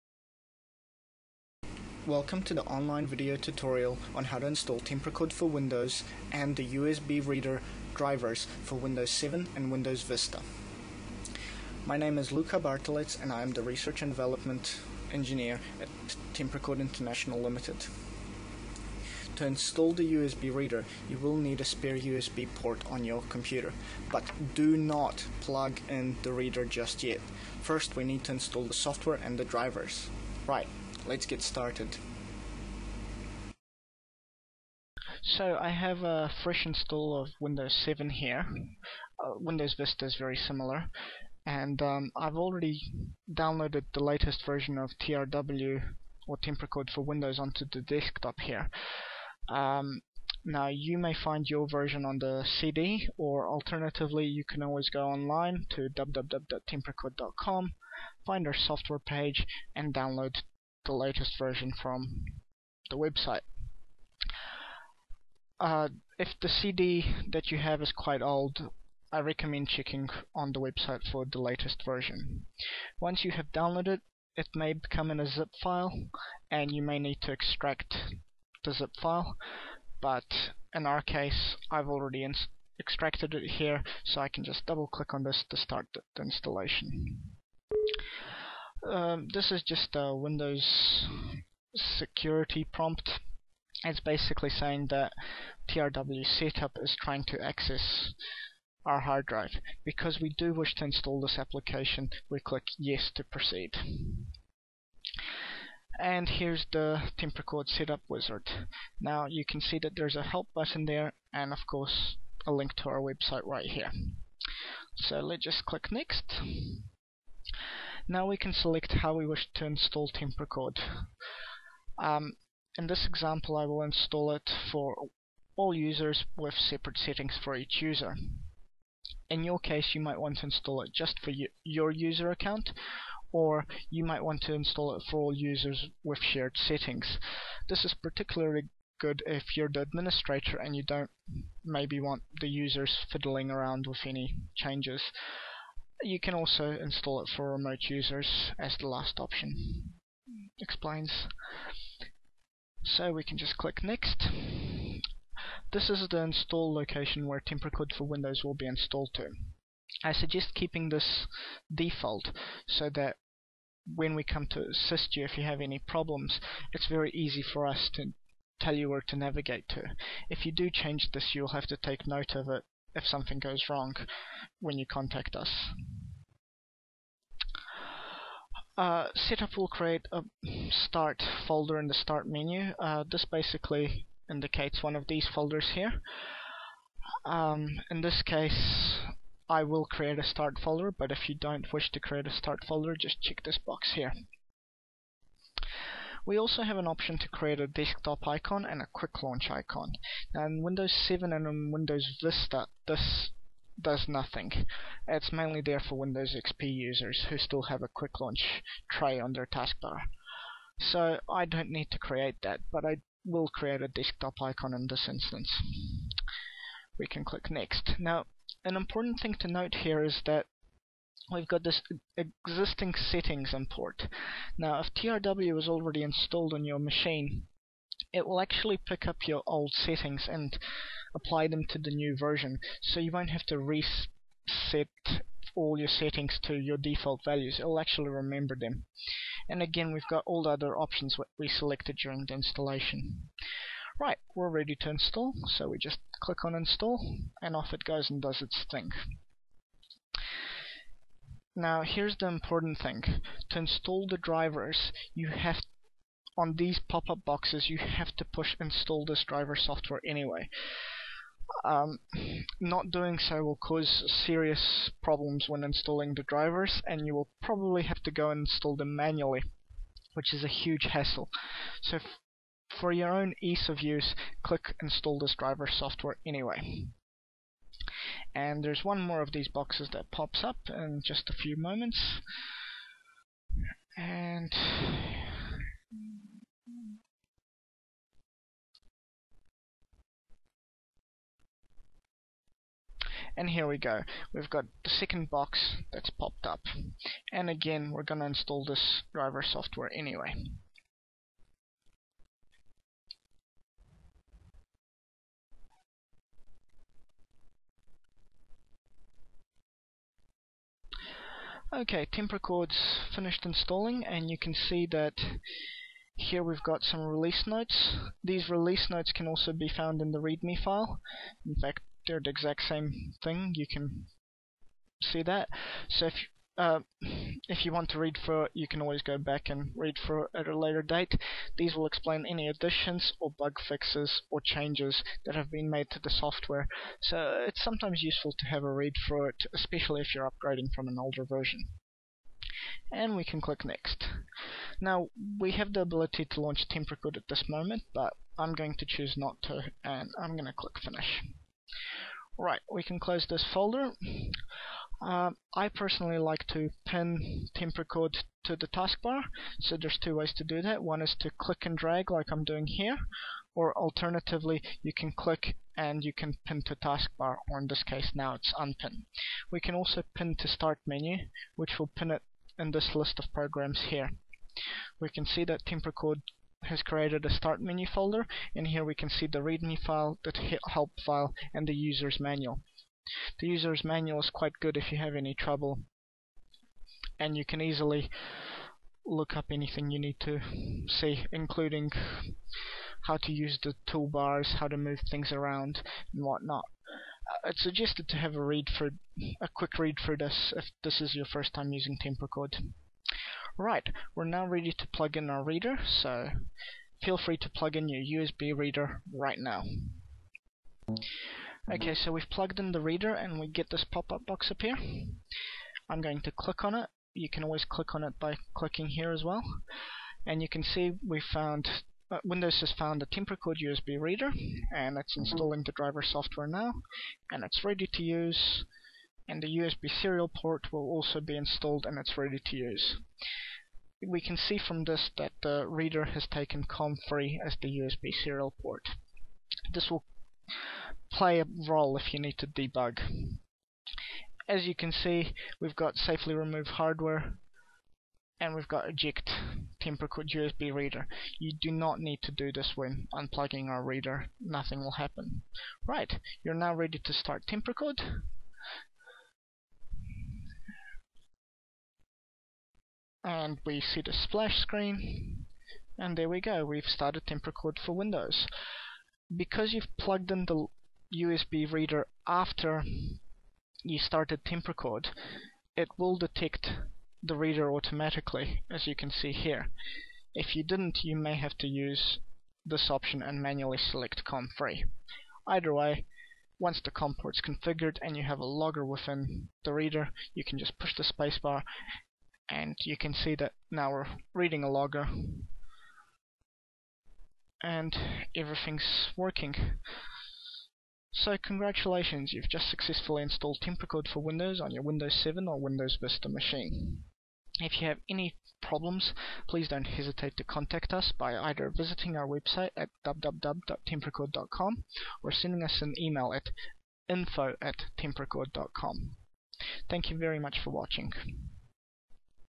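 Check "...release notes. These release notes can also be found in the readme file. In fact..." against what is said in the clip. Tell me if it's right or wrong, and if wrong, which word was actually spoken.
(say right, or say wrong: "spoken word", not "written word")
right.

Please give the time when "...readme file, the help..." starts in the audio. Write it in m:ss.
6:19.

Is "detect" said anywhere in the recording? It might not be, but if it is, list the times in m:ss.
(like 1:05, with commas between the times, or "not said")
7:56.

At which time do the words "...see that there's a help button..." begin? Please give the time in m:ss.
1:49.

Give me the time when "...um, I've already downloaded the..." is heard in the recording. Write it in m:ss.
0:41.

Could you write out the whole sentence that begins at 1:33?
It's basically saying that TRW setup is trying to access our hard drive.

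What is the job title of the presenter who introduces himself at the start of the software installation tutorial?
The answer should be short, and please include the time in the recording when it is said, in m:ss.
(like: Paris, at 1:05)
Research and Development Engineer, at 0:13.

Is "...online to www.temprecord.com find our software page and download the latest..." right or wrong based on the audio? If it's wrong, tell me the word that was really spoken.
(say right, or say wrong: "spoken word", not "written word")
right.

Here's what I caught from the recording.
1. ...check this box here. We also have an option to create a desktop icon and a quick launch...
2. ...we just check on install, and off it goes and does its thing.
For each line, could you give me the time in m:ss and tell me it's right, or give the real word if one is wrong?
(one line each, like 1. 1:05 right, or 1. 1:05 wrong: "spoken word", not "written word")
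1. 3:13 right
2. 4:05 wrong: "click", not "check".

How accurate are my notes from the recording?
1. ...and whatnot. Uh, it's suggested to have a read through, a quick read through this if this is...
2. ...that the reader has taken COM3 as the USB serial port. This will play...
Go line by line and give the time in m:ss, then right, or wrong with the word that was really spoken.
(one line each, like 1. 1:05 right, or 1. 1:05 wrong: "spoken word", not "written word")
1. 6:36 right
2. 7:15 right.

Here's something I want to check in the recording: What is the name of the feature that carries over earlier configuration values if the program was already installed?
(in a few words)
Existing settings import.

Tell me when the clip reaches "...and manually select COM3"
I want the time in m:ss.
8:03.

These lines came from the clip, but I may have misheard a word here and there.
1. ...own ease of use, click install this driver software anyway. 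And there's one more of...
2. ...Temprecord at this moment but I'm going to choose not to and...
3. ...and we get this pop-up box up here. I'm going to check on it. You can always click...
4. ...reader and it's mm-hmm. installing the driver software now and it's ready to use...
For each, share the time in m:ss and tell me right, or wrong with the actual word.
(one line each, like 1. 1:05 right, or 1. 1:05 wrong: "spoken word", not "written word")
1. 4:33 right
2. 5:46 right
3. 6:53 wrong: "click", not "check"
4. 7:03 right.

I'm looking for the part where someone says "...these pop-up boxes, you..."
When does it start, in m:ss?
4:16.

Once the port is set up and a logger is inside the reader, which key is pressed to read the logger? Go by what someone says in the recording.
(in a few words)
Spacebar.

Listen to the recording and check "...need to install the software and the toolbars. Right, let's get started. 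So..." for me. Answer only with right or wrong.
wrong.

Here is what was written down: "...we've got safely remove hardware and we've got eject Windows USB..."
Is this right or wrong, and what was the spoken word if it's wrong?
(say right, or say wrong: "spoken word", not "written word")
wrong: "Temprecord", not "Windows".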